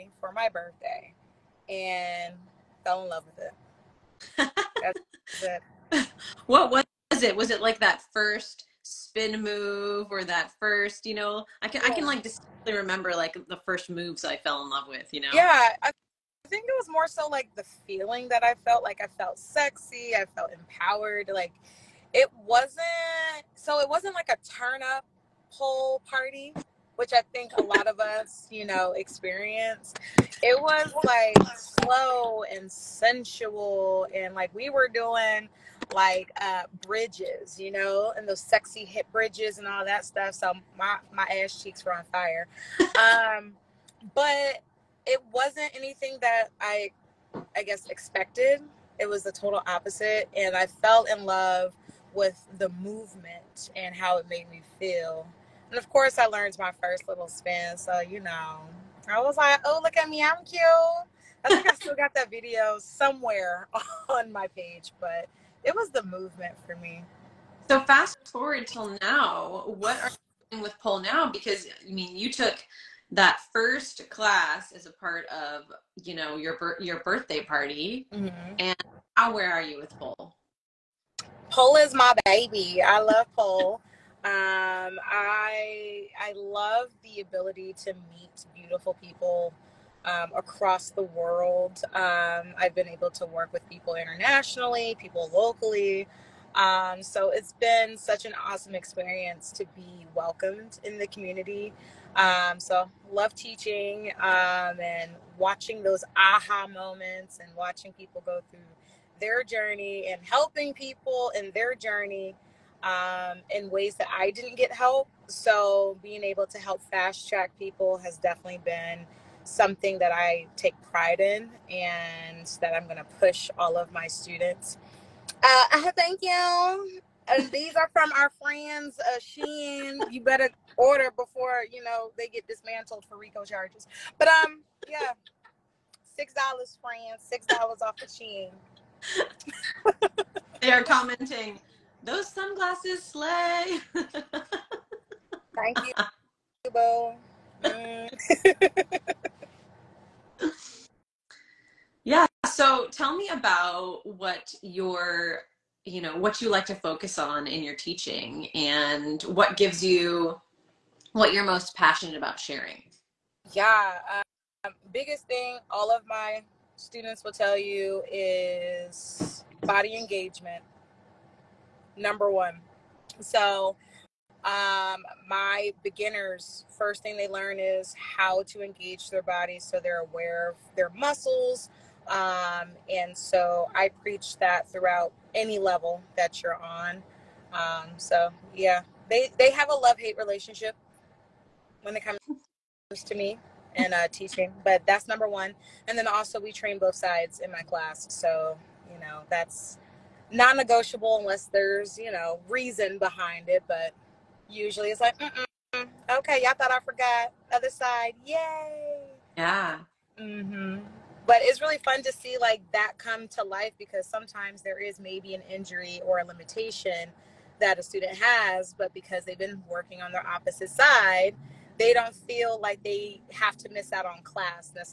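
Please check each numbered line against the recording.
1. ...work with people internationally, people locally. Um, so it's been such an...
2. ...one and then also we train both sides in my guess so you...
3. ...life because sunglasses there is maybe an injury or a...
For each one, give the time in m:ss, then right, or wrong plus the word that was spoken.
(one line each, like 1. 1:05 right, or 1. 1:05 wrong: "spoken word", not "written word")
1. 1:33 right
2. 3:15 wrong: "class", not "guess"
3. 3:33 wrong: "sometimes", not "sunglasses".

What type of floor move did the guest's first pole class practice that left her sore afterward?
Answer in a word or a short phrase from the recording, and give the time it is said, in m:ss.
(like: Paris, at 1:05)
Hip bridges, at 0:38.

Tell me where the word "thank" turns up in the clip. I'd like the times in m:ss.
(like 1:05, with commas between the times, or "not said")
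2:05, 2:23.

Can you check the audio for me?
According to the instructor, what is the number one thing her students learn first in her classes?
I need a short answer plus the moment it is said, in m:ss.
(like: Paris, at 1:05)
Body engagement, at 2:49.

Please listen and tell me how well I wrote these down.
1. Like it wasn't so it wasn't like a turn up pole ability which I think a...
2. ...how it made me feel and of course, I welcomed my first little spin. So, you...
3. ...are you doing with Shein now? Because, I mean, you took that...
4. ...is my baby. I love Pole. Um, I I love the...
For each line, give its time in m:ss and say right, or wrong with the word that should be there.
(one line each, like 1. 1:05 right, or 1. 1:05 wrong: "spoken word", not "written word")
1. 0:21 wrong: "party", not "ability"
2. 0:53 wrong: "learned", not "welcomed"
3. 1:10 wrong: "Pole", not "Shein"
4. 1:21 right.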